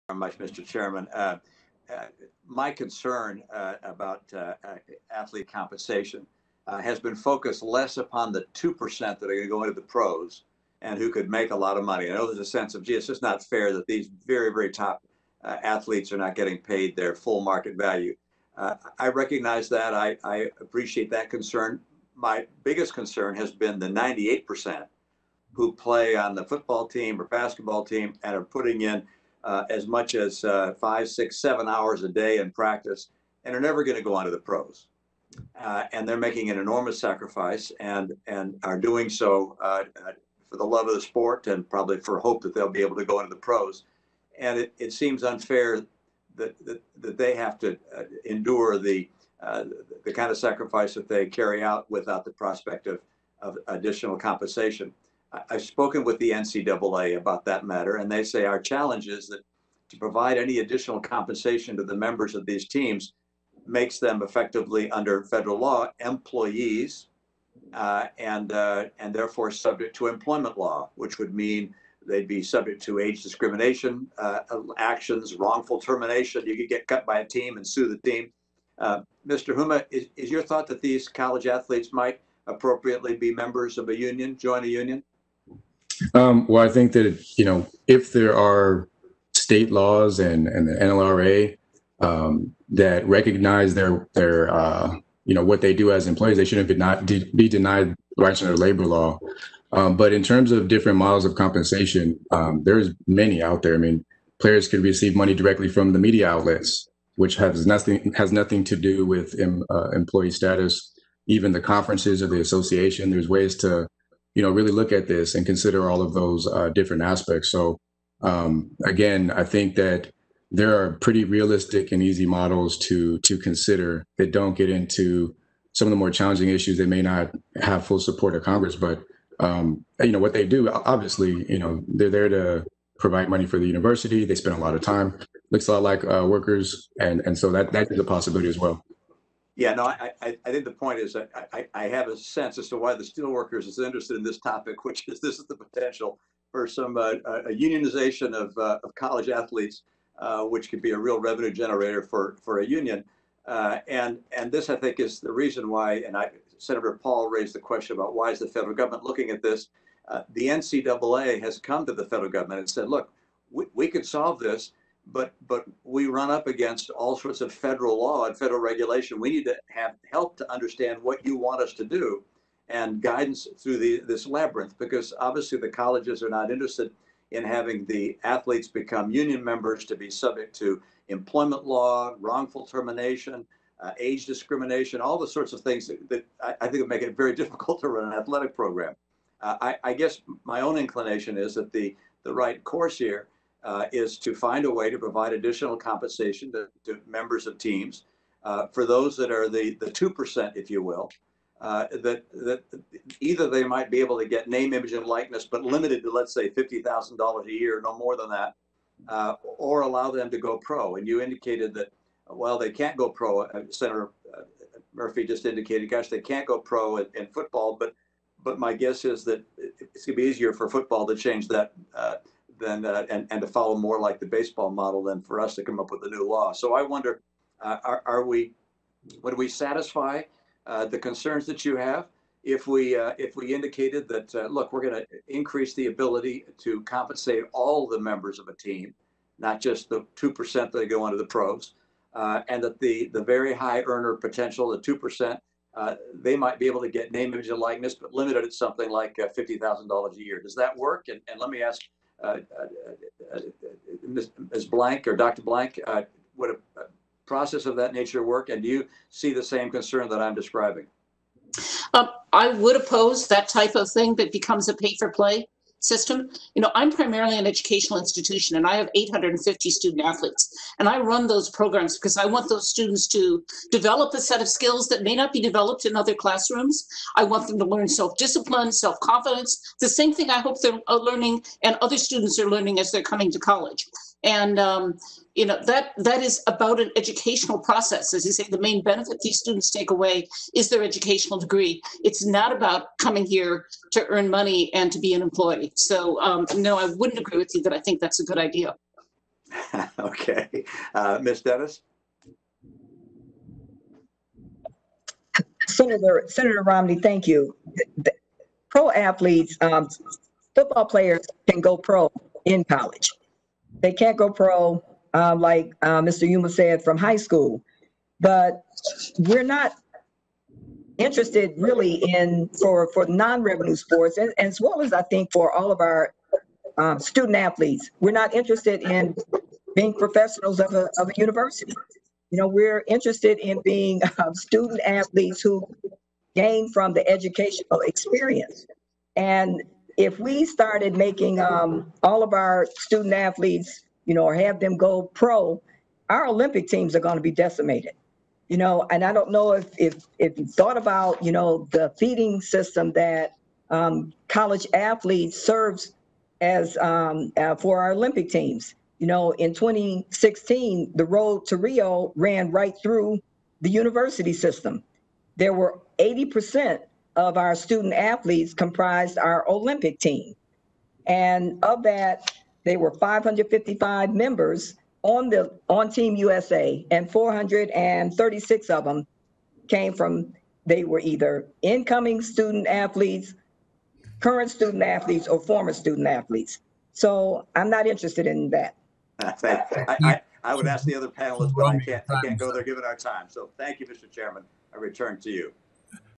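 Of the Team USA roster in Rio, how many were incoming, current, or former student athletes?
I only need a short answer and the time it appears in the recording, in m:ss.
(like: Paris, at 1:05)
436, at 6:17.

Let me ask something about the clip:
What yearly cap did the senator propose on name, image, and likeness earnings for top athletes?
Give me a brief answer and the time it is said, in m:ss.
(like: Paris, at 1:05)
$50,000, at 3:26.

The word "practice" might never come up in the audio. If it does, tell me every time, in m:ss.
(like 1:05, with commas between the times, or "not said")
0:32.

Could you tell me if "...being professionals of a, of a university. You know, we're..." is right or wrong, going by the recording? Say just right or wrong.
right.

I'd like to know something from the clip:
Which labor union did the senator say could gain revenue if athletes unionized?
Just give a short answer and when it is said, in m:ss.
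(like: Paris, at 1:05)
steelworkers, at 2:23.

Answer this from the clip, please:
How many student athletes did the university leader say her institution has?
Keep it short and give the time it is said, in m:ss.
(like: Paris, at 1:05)
850, at 4:28.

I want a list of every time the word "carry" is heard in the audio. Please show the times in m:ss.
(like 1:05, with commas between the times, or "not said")
0:51.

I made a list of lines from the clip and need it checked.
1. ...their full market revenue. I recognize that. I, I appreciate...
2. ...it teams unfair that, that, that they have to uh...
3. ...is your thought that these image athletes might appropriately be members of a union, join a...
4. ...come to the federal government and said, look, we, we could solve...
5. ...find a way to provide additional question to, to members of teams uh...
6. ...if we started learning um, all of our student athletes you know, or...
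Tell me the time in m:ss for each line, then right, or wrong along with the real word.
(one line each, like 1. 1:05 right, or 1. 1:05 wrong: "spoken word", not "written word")
1. 0:16 wrong: "value", not "revenue"
2. 0:44 wrong: "seems", not "teams"
3. 1:20 wrong: "college", not "image"
4. 2:41 right
5. 3:14 wrong: "compensation", not "question"
6. 5:39 wrong: "making", not "learning".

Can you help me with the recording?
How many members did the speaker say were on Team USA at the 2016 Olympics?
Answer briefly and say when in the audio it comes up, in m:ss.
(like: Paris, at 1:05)
555, at 6:12.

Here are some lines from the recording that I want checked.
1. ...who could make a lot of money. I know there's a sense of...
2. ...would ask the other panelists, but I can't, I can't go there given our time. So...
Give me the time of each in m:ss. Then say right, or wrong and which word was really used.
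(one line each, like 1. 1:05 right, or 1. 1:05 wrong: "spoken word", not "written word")
1. 0:10 right
2. 6:30 right.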